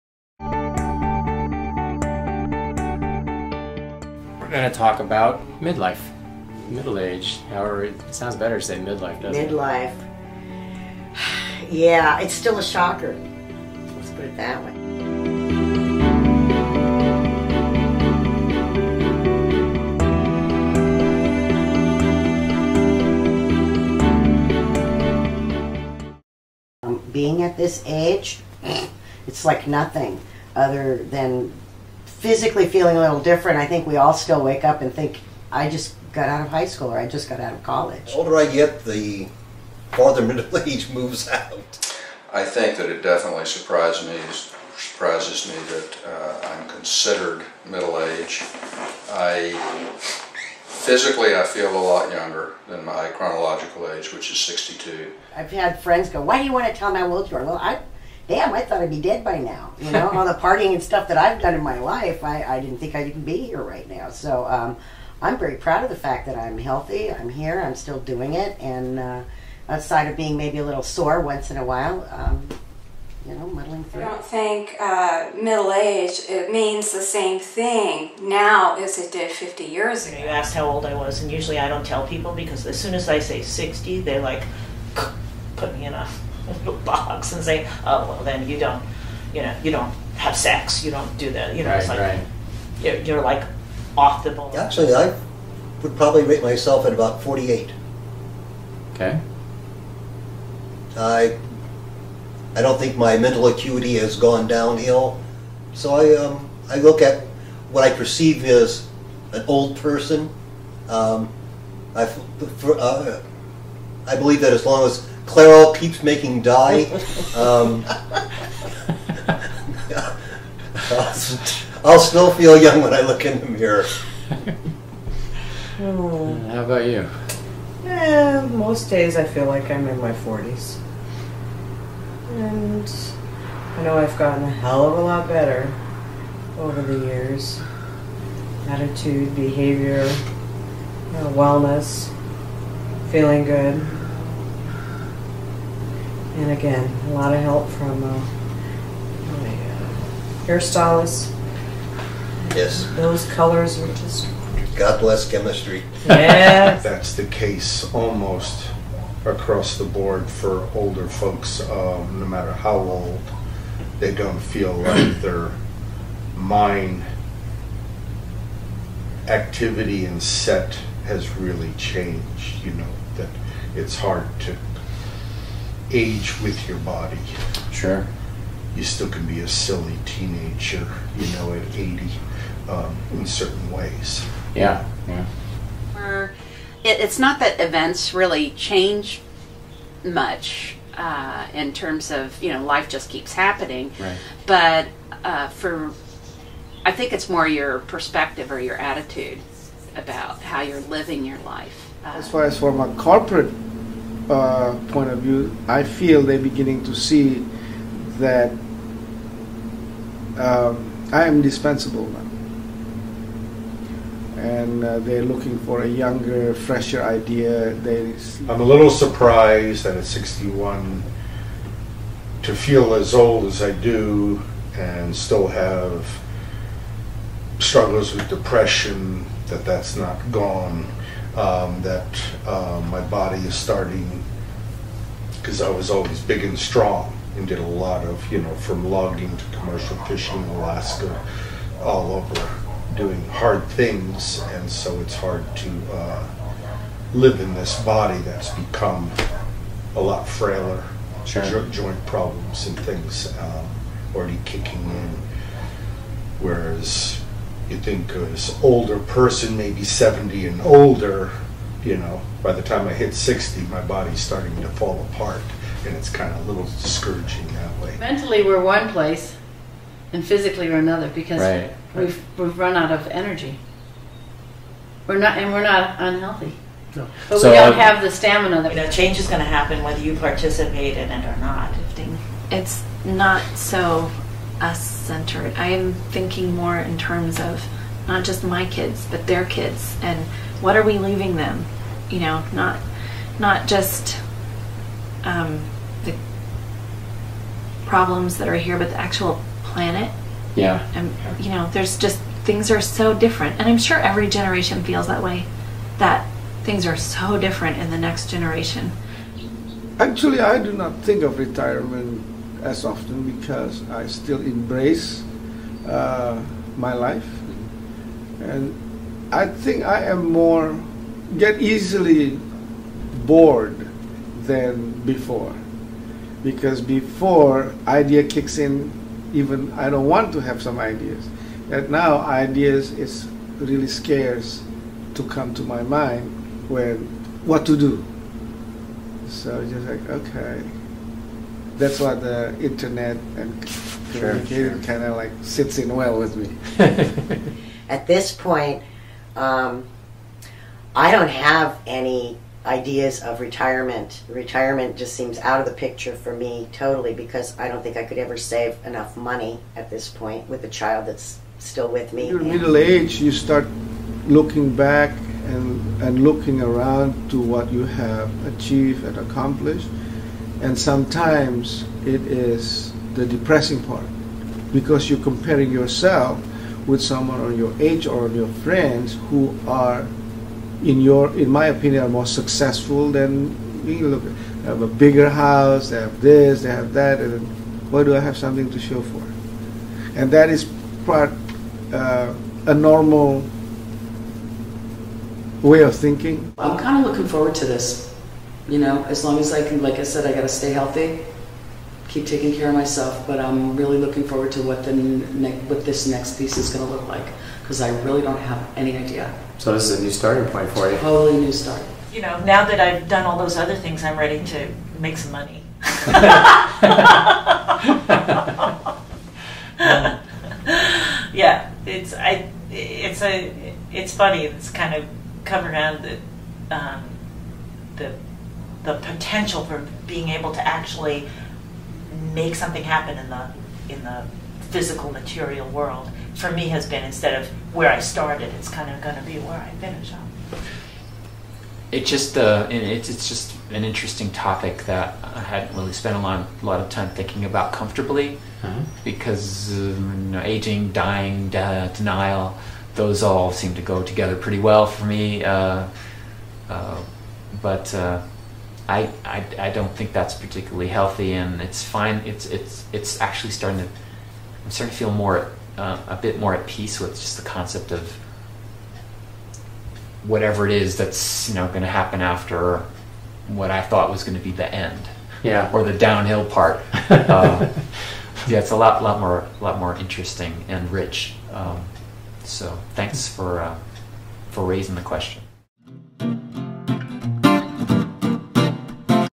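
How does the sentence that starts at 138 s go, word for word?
Attitude, behavior, you know, wellness, feeling good.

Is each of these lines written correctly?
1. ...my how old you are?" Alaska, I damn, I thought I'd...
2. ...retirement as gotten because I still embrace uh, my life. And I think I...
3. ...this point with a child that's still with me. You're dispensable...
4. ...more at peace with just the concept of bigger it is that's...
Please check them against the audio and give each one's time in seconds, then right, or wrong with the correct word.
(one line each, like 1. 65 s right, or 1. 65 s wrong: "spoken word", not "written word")
1. 56 s wrong: "Well", not "Alaska"
2. 311 s wrong: "often", not "gotten"
3. 359 s wrong: "middle", not "dispensable"
4. 466 s wrong: "whatever", not "bigger".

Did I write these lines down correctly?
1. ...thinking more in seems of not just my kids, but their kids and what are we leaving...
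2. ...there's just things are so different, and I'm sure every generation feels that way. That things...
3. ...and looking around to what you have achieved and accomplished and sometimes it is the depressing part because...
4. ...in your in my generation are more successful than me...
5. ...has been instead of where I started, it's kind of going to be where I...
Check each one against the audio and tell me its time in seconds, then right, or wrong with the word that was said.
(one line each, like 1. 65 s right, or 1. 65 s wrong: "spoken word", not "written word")
1. 285 s wrong: "terms", not "seems"
2. 301 s right
3. 366 s right
4. 380 s wrong: "opinion", not "generation"
5. 436 s right.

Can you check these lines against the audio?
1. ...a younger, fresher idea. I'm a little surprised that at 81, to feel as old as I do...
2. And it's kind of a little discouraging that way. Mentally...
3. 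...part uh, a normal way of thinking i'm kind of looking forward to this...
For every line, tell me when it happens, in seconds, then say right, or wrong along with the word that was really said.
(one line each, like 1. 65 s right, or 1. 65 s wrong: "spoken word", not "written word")
1. 215 s wrong: "61", not "81"
2. 265 s right
3. 391 s right.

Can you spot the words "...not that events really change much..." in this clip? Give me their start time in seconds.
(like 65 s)
187 s.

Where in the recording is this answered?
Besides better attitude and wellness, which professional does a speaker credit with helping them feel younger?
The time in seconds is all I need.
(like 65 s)
150 s.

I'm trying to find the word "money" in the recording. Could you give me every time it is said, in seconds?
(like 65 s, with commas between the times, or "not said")
359 s, 415 s.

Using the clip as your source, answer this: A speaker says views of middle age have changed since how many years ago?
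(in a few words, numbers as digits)
50 years.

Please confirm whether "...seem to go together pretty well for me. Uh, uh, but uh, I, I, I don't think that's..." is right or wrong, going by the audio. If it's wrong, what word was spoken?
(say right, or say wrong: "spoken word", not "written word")
right.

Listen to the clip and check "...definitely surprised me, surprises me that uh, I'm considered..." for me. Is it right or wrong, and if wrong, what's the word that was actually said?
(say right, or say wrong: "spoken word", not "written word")
right.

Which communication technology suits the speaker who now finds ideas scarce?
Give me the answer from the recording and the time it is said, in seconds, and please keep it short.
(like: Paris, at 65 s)
The internet, at 342 s.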